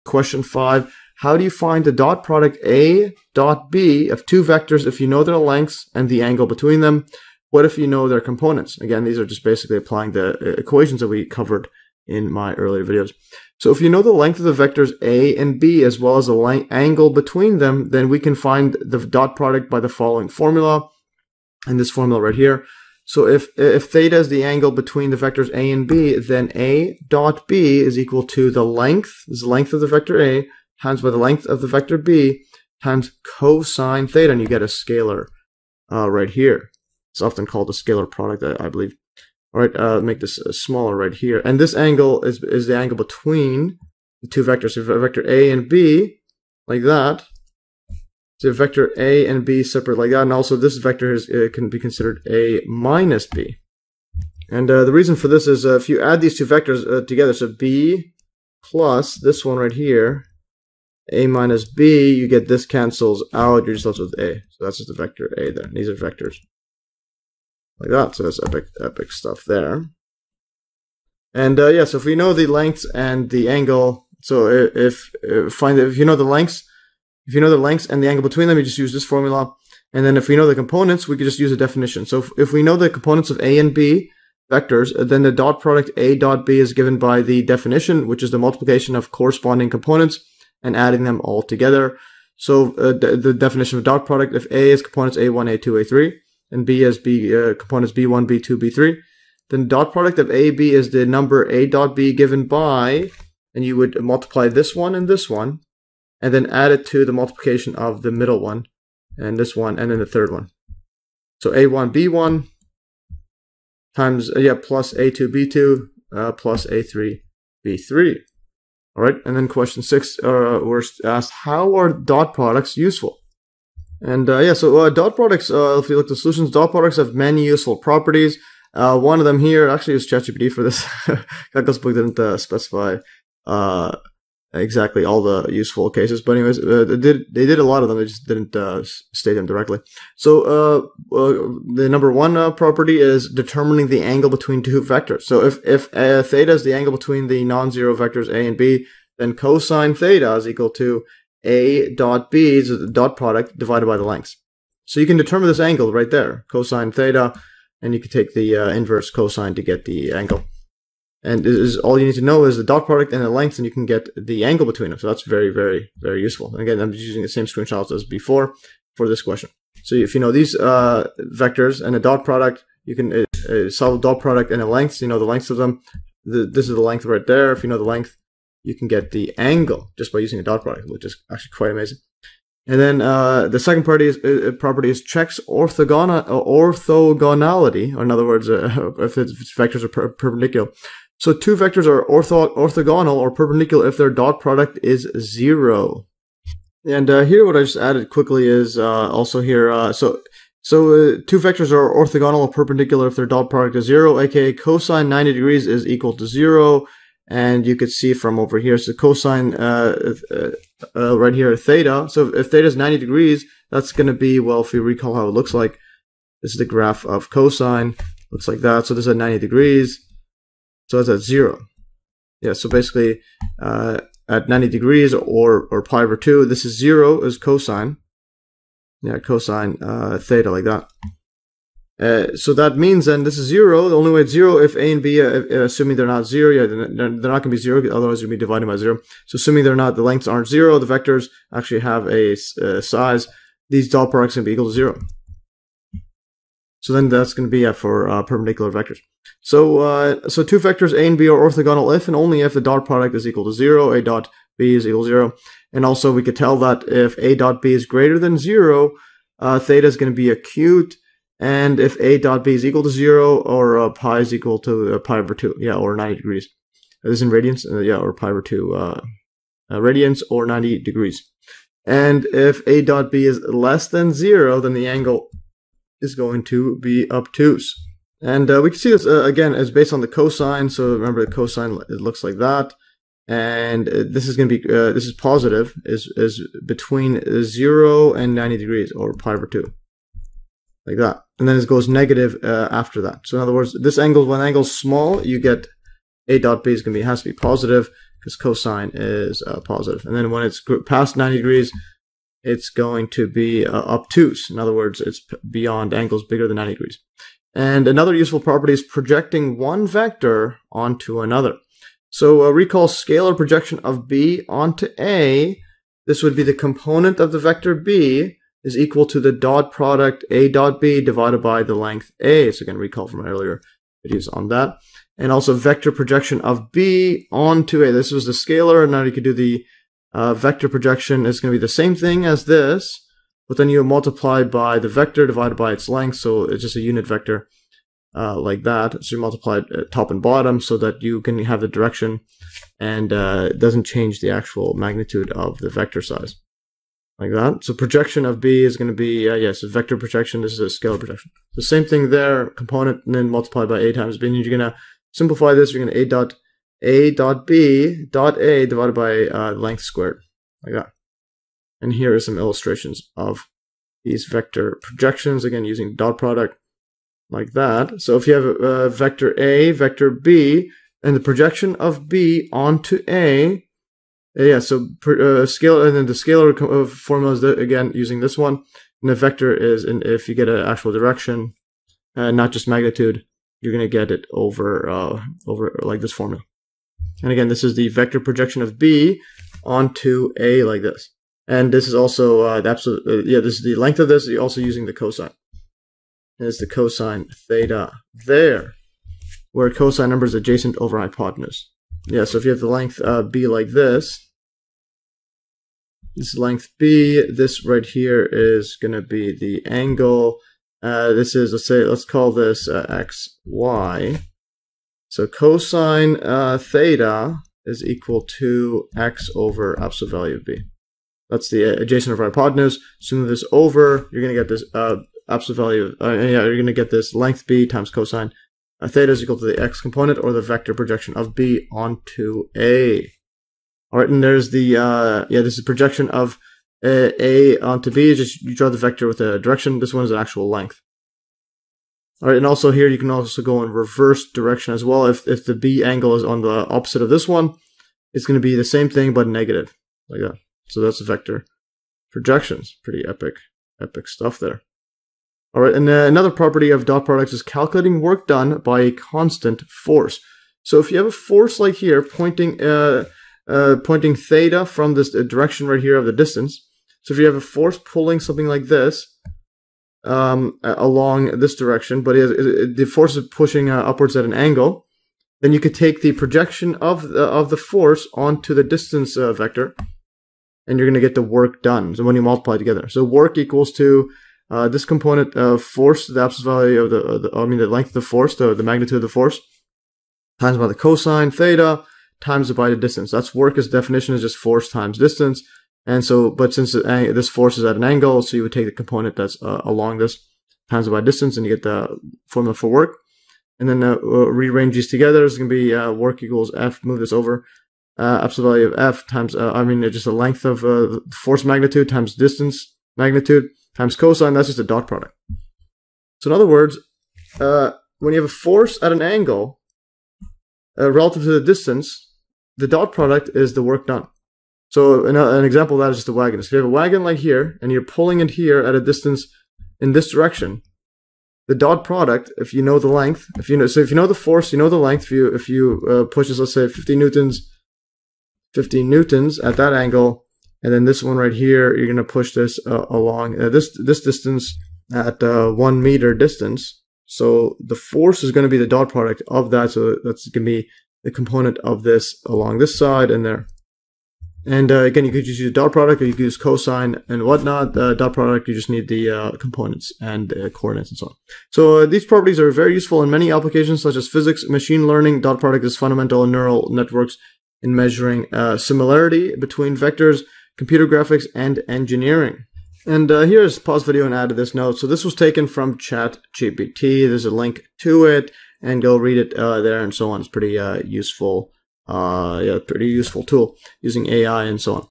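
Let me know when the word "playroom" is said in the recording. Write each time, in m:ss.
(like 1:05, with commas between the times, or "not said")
not said.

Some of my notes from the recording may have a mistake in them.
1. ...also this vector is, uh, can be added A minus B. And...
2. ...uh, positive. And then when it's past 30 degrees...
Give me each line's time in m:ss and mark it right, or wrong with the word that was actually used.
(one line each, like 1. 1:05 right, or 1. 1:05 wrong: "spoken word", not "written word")
1. 0:50 wrong: "considered", not "added"
2. 4:59 wrong: "90", not "30".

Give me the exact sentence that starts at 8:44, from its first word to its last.
So an, uh, an example of that is just a wagon.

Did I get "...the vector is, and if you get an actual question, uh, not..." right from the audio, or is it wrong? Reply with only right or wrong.
wrong.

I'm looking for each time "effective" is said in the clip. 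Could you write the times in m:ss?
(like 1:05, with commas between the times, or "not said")
not said.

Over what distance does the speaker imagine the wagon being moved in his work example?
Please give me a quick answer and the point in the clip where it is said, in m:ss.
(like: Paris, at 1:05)
1 meter, at 9:05.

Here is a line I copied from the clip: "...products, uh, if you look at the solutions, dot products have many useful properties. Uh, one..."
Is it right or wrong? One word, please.
right.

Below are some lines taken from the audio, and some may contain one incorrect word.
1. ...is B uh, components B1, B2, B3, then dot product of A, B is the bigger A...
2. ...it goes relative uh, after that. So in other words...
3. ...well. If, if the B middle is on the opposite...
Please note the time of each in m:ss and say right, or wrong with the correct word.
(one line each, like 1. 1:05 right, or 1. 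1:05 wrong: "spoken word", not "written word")
1. 1:36 wrong: "number", not "bigger"
2. 4:51 wrong: "negative", not "relative"
3. 7:24 wrong: "angle", not "middle".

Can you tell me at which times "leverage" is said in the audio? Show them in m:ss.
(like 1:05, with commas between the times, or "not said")
not said.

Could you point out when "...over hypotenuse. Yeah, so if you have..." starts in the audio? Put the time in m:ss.
6:40.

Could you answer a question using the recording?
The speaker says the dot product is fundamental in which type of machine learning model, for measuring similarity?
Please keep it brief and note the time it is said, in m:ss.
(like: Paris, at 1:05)
neural networks, at 9:26.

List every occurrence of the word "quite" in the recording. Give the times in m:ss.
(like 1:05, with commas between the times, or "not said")
3:01.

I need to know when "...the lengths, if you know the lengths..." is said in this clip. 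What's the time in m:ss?
1:16.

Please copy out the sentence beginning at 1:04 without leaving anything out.
So that's just the vector a there.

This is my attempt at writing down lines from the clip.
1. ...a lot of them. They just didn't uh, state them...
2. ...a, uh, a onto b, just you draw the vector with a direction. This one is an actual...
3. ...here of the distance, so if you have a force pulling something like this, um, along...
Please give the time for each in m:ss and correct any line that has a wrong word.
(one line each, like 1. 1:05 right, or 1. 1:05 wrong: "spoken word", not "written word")
1. 2:17 right
2. 7:16 right
3. 7:45 right.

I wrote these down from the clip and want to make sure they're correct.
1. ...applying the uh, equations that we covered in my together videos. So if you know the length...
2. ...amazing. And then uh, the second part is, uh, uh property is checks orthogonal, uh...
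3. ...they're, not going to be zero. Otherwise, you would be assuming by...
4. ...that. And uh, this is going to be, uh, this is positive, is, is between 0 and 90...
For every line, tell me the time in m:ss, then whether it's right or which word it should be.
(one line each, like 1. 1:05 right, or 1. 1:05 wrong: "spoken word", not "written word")
1. 0:09 wrong: "earlier", not "together"
2. 3:01 right
3. 3:56 wrong: "dividing", not "assuming"
4. 4:42 right.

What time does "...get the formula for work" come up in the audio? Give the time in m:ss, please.
8:21.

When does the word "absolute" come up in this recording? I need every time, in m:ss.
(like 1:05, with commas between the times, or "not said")
6:32, 6:59, 7:05, 8:06, 8:28.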